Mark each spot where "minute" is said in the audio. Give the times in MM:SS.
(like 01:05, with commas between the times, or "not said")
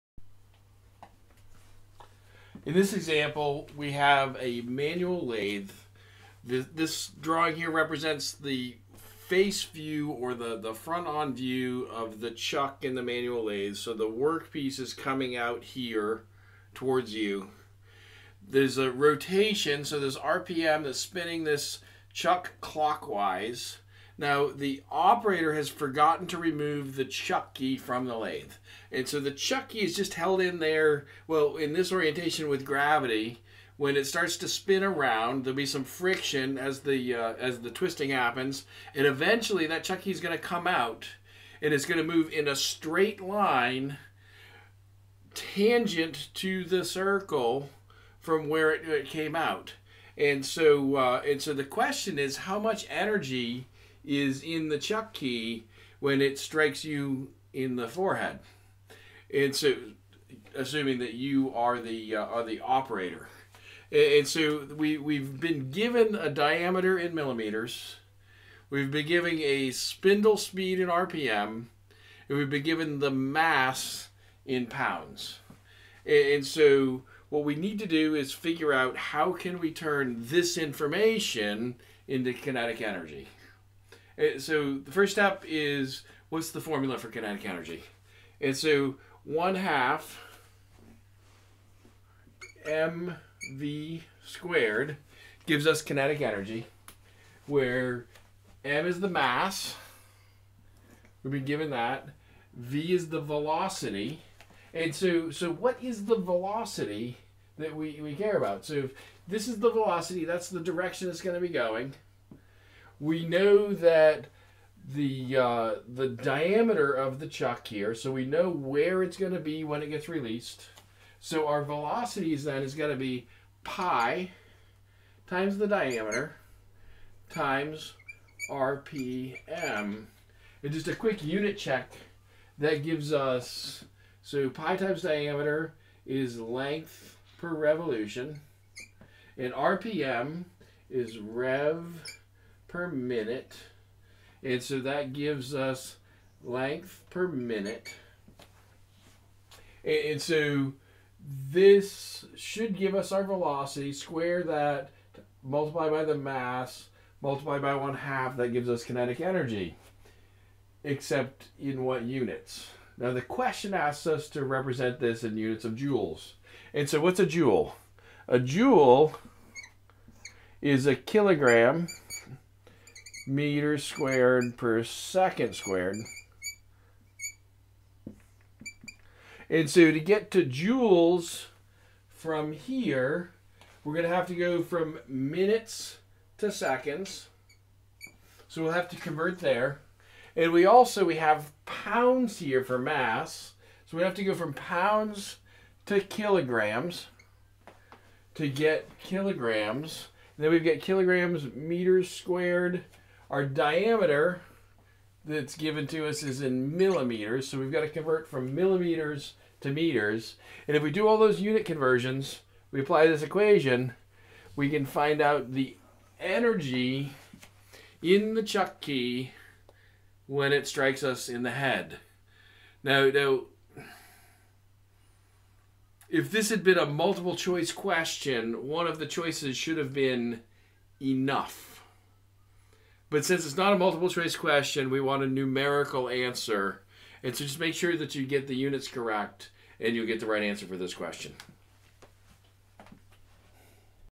02:22, 02:27, 03:05.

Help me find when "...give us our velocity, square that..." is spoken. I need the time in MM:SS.
02:32.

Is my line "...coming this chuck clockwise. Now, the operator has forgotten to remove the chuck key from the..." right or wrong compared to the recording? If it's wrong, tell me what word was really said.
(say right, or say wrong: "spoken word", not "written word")
wrong: "spinning", not "coming".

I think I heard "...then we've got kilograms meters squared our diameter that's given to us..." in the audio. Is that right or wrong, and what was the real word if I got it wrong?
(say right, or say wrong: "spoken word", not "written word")
right.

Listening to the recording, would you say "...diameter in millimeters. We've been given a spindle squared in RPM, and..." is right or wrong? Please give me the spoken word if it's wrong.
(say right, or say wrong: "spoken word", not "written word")
wrong: "speed", not "squared".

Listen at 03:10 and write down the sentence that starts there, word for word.
And we also, we have pounds here for mass.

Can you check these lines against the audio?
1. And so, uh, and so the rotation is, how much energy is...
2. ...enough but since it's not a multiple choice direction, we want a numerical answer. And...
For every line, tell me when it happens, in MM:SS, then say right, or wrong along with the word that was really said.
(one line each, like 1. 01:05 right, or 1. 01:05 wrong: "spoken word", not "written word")
1. 00:50 wrong: "question", not "rotation"
2. 03:51 wrong: "question", not "direction".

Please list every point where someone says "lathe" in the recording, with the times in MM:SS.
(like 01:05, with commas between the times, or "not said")
00:05, 00:13, 00:28.